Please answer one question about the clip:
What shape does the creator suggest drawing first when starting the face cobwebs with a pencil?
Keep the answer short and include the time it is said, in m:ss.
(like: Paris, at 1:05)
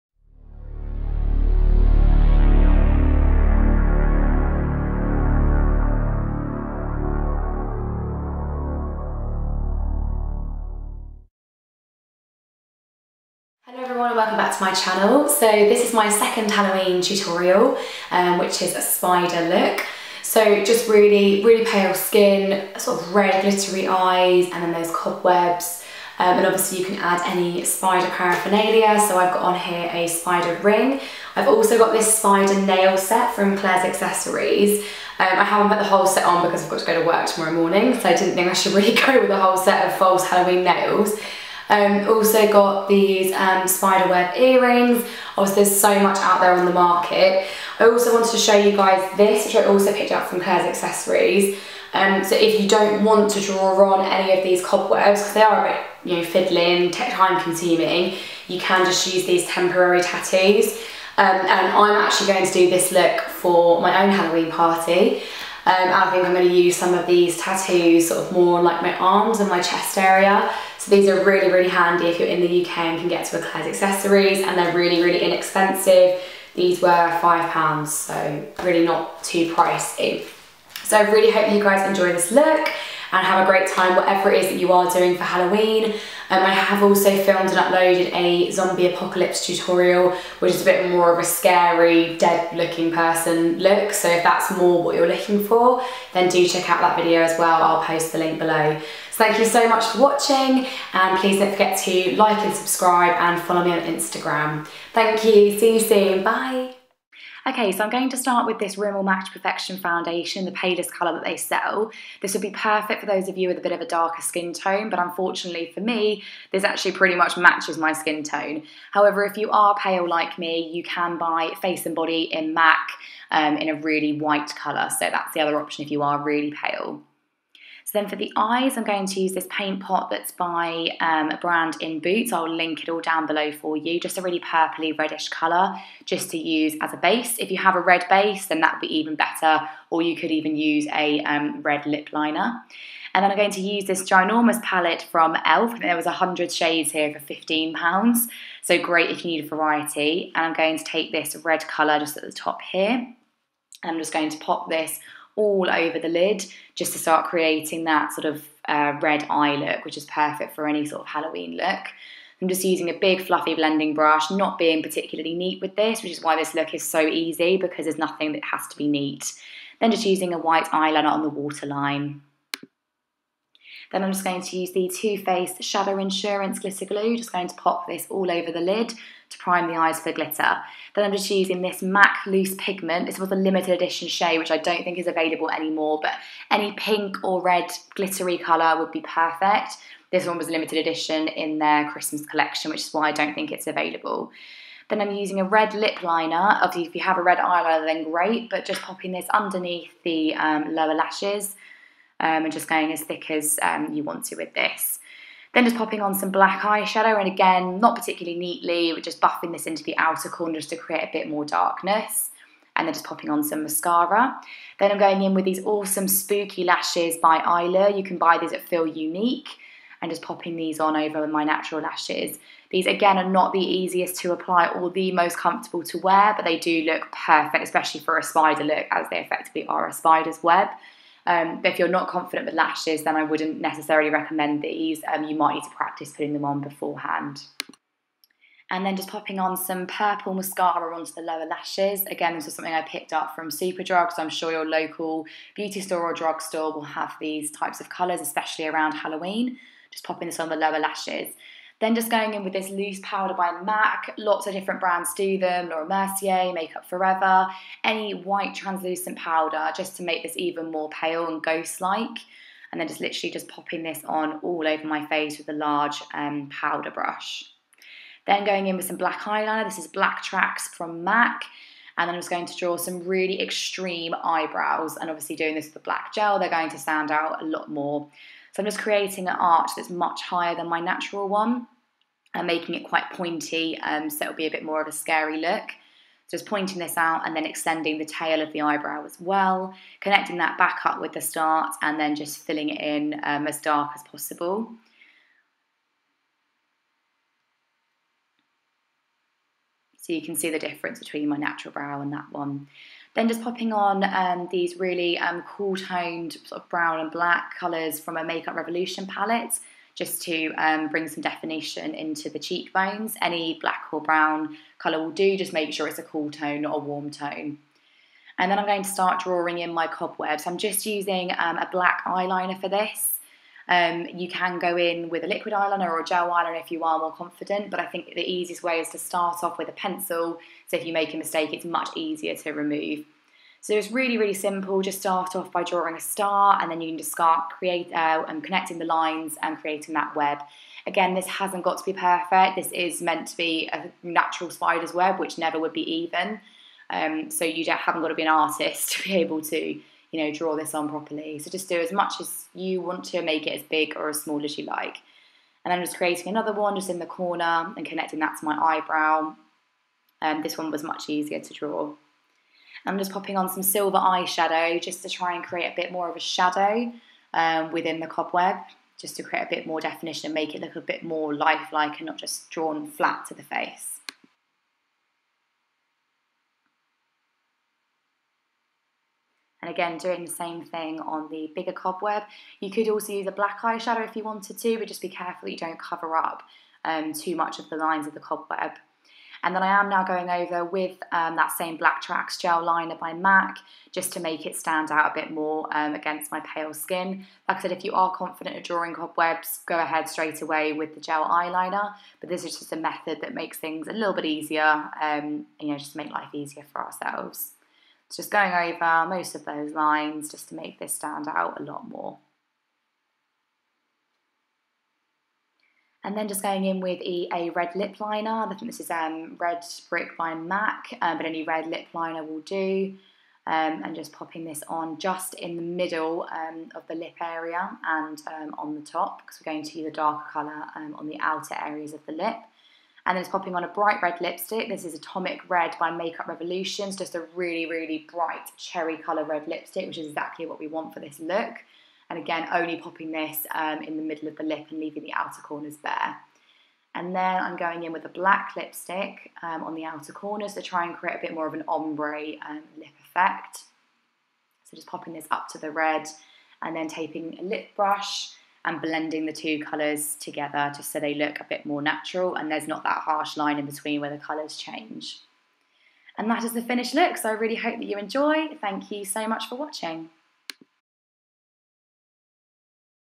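A star, at 5:35.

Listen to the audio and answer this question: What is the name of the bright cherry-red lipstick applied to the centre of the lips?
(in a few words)
Atomic Red.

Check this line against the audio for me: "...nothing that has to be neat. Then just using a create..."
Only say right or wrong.
wrong.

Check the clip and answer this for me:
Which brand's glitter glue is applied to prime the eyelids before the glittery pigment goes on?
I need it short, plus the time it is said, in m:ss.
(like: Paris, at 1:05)
Too Faced, at 2:54.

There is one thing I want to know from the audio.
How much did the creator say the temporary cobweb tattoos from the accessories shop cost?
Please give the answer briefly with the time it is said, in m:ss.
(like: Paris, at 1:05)
£5, at 1:16.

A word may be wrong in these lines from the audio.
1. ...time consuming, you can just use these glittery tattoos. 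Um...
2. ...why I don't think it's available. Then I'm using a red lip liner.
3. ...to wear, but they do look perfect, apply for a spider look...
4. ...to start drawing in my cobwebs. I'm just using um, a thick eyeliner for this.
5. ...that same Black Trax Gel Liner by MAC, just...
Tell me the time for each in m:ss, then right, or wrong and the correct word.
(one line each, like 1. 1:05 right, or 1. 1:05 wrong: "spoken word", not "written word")
1. 0:56 wrong: "temporary", not "glittery"
2. 3:12 right
3. 3:45 wrong: "especially", not "apply"
4. 5:18 wrong: "black", not "thick"
5. 6:31 right.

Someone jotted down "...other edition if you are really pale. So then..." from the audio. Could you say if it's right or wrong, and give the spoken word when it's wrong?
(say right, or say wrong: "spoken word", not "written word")
wrong: "option", not "edition".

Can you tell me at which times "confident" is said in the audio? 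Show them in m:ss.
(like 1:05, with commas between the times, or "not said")
3:52, 5:27, 6:38.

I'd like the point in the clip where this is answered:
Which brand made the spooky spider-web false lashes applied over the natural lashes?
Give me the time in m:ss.
3:36.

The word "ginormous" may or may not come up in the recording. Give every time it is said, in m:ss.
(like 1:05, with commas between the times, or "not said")
2:24.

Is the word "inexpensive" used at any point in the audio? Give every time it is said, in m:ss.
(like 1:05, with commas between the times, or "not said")
1:15.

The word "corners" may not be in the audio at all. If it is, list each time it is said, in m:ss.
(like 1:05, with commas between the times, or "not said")
3:30, 5:57, 7:25, 7:30.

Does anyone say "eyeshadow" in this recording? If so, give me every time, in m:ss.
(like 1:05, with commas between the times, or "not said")
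3:26, 6:03, 6:23.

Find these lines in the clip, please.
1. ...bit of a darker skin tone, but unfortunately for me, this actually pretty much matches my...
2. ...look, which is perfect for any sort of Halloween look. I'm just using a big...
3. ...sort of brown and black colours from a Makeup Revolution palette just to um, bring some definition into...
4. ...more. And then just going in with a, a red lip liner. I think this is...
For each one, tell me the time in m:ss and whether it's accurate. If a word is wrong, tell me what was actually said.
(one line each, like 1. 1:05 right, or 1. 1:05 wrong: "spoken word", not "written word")
1. 1:53 right
2. 2:39 right
3. 5:06 right
4. 6:51 right.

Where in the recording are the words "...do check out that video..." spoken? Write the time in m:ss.
1:36.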